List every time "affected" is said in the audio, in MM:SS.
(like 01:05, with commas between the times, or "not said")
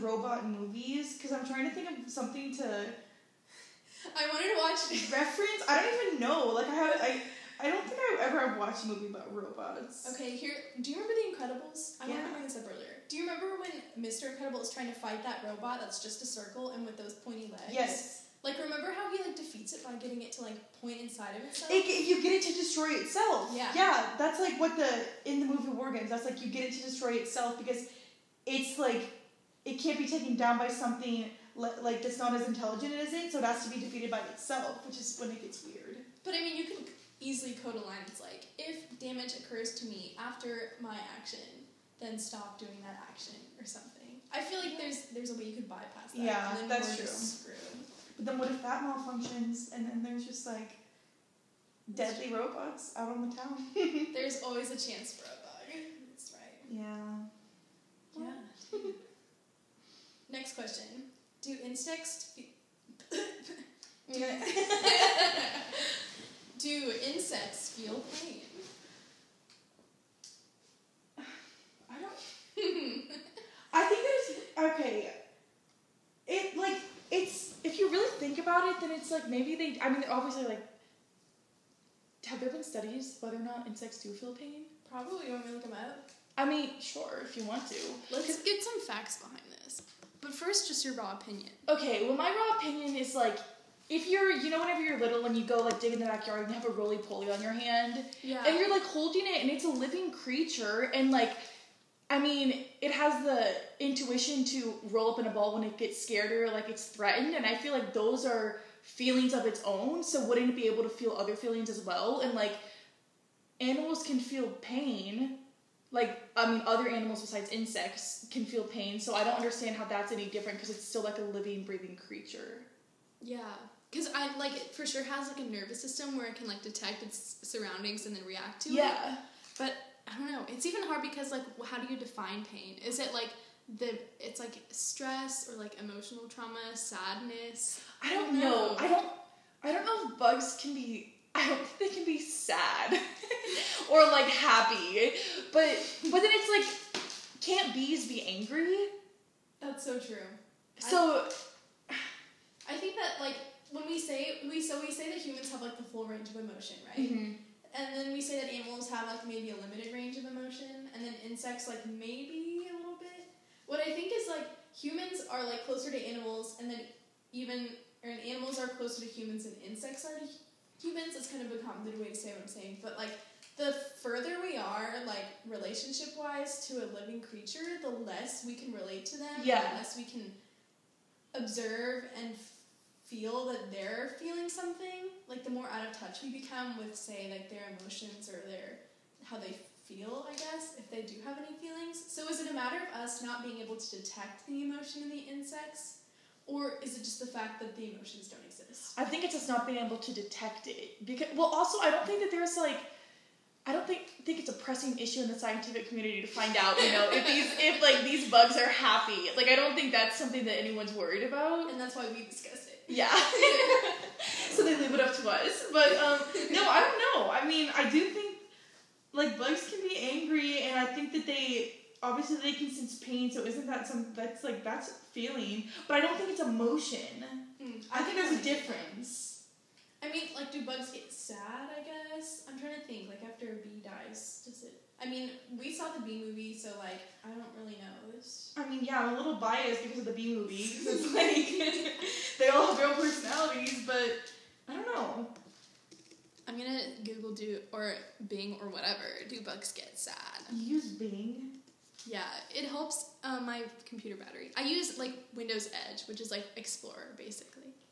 not said.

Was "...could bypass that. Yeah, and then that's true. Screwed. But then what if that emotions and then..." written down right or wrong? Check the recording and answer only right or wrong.
wrong.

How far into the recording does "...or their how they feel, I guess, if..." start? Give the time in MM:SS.
03:08.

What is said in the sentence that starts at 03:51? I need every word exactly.
I guess I'm trying to think.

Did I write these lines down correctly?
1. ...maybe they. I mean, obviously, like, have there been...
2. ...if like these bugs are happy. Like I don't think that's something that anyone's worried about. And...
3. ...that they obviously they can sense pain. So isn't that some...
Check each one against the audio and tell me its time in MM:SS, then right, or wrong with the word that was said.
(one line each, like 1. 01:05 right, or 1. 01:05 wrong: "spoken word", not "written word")
1. 01:19 right
2. 03:27 right
3. 03:41 right.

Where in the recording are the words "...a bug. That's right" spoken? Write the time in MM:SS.
00:55.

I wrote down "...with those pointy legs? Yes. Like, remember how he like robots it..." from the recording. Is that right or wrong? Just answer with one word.
wrong.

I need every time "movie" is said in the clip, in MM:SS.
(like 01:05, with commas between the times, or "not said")
00:00, 00:08, 00:25, 03:56, 04:00.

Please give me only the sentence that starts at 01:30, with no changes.
But first, just your raw opinion.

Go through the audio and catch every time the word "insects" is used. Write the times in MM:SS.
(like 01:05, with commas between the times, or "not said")
01:01, 01:07, 01:23, 01:57, 02:41, 02:49, 03:15.